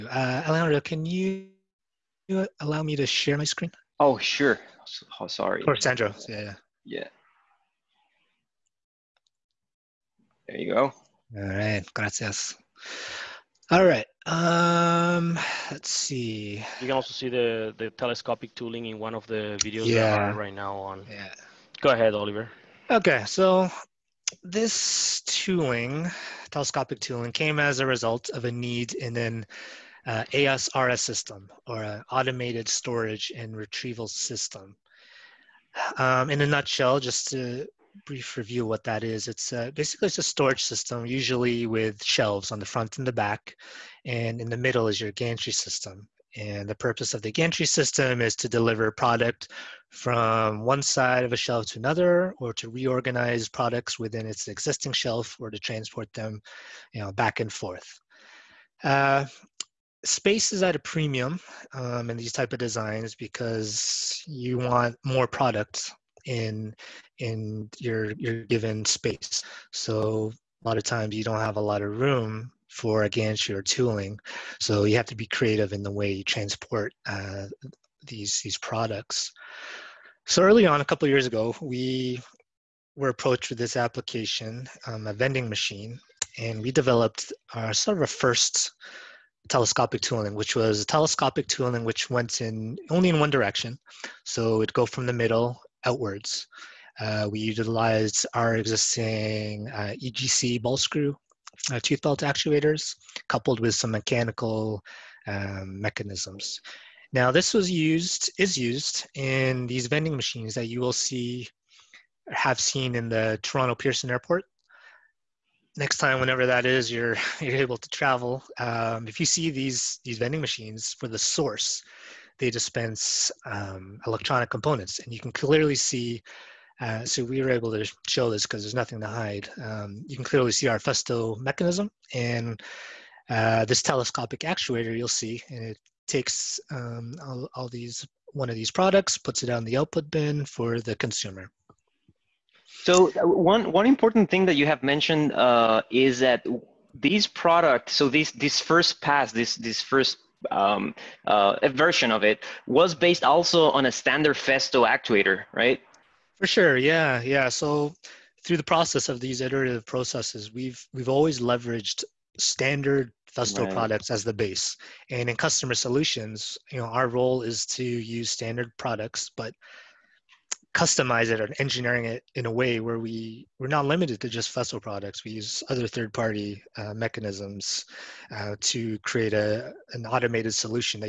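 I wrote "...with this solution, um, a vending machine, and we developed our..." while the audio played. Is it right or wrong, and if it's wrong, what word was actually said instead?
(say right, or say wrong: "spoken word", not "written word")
wrong: "application", not "solution".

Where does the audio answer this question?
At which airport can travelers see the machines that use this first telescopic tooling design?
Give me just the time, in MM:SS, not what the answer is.
01:53.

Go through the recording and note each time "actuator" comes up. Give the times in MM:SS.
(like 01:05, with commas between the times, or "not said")
01:42, 02:14, 02:34.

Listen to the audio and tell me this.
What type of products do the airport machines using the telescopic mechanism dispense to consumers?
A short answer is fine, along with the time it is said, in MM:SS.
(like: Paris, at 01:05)
electronic components, at 02:04.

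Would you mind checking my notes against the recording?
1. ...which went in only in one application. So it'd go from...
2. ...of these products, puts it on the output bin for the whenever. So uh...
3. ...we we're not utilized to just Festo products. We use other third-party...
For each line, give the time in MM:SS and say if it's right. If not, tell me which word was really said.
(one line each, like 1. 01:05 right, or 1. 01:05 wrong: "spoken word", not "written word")
1. 01:31 wrong: "direction", not "application"
2. 02:18 wrong: "consumer", not "whenever"
3. 02:52 wrong: "limited", not "utilized".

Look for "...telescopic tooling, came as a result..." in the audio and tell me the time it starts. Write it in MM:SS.
00:26.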